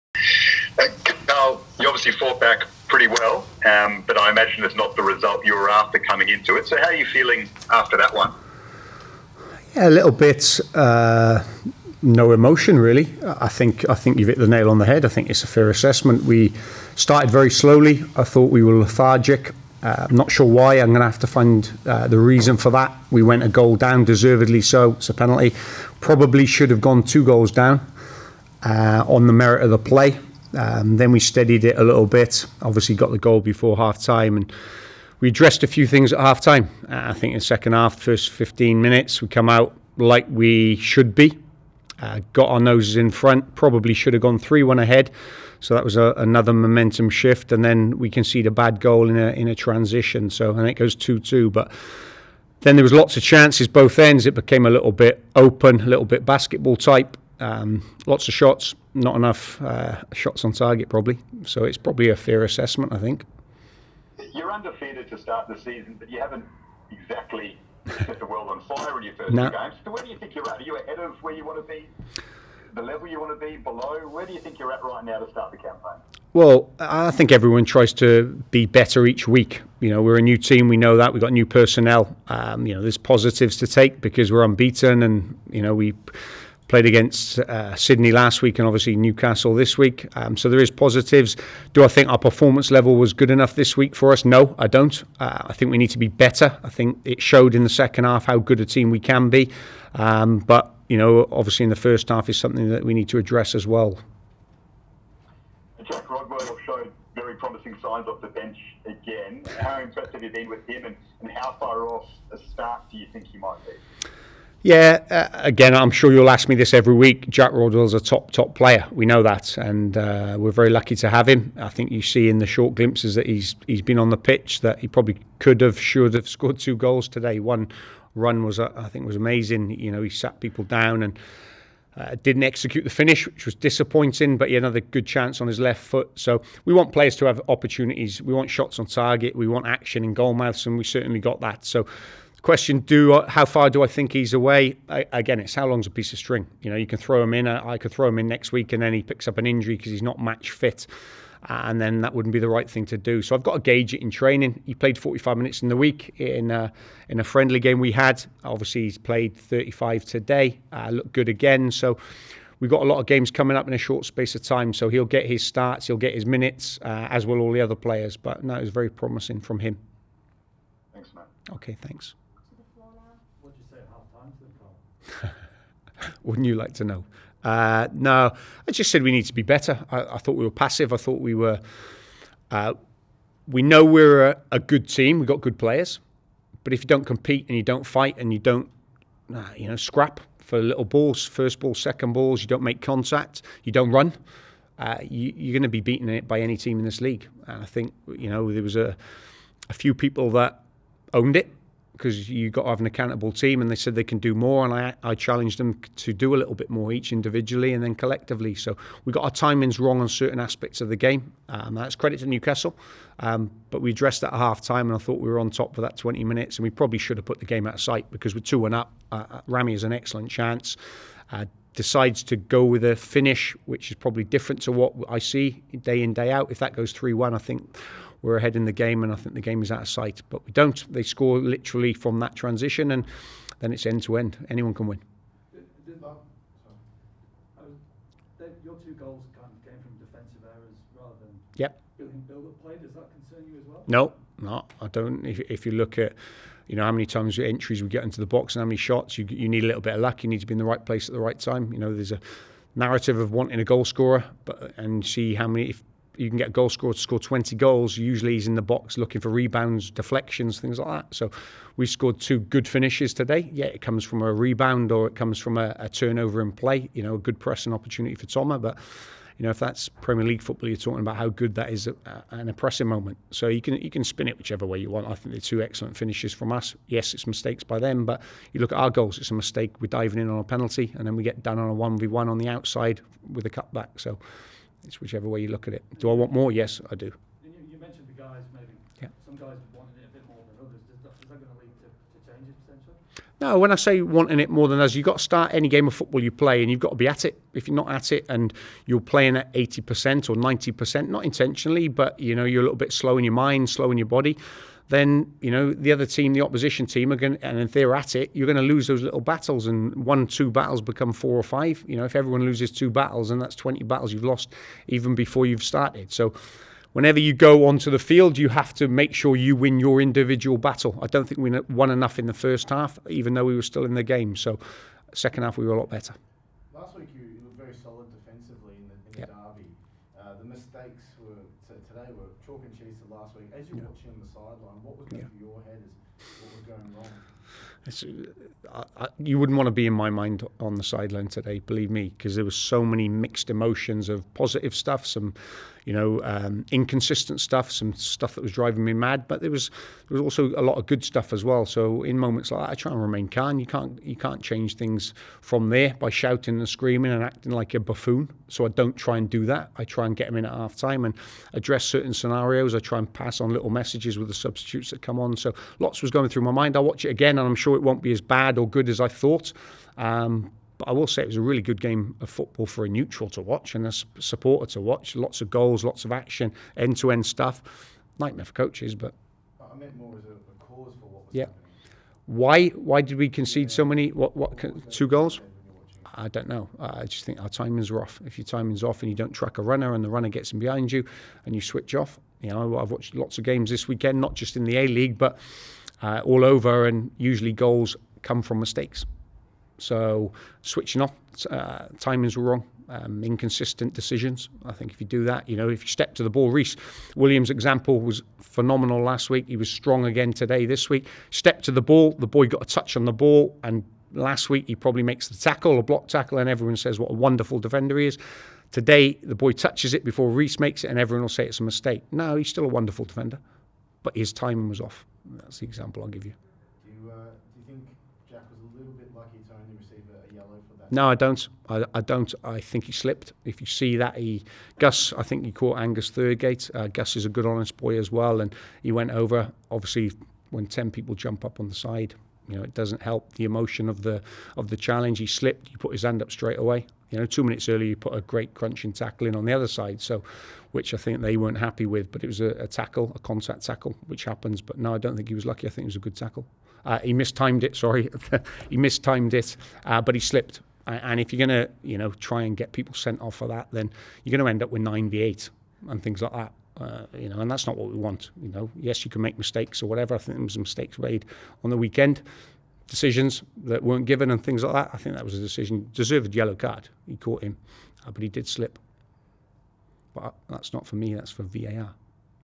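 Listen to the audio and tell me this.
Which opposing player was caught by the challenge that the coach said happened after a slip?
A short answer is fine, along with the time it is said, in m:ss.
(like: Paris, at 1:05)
Angus Thurgate, at 7:15.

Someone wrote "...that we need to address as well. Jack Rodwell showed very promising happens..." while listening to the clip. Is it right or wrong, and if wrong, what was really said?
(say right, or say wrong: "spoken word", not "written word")
wrong: "signs", not "happens".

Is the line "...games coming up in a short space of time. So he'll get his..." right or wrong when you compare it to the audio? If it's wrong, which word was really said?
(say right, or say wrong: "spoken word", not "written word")
right.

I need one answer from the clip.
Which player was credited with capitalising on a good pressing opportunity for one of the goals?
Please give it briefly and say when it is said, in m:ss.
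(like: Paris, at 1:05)
Thomas, at 4:28.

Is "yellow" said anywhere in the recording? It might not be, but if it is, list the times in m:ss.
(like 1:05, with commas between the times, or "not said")
7:56.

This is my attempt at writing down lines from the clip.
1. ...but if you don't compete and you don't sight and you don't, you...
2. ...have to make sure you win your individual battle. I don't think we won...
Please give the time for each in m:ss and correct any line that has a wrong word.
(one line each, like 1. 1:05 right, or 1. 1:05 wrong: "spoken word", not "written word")
1. 3:06 wrong: "fight", not "sight"
2. 5:18 right.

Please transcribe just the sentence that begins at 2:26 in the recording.
You know, you can throw him in.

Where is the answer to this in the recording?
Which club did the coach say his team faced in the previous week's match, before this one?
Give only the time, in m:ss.
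1:27.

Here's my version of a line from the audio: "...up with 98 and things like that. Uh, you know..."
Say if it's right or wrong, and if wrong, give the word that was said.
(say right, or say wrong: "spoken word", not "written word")
right.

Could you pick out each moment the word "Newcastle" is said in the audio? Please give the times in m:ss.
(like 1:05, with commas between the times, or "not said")
1:28, 3:32.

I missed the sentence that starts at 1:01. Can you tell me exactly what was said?
So it's probably a fair assessment, I think.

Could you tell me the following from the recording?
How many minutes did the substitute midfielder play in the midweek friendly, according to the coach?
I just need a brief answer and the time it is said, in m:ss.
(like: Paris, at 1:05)
45, at 2:34.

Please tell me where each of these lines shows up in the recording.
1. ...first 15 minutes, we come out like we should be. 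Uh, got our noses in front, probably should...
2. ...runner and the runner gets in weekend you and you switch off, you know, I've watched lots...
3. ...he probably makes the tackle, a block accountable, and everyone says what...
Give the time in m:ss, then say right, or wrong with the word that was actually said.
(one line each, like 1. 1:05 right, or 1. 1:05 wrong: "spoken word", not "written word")
1. 0:38 right
2. 6:29 wrong: "behind", not "weekend"
3. 6:54 wrong: "tackle", not "accountable".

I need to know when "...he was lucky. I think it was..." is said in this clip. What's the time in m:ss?
7:35.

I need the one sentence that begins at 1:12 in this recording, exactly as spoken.
The level you want to be below?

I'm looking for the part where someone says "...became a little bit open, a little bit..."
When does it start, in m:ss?
0:54.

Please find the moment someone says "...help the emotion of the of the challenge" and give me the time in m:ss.
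7:23.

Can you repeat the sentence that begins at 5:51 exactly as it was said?
So in moments like that, I try and remain calm.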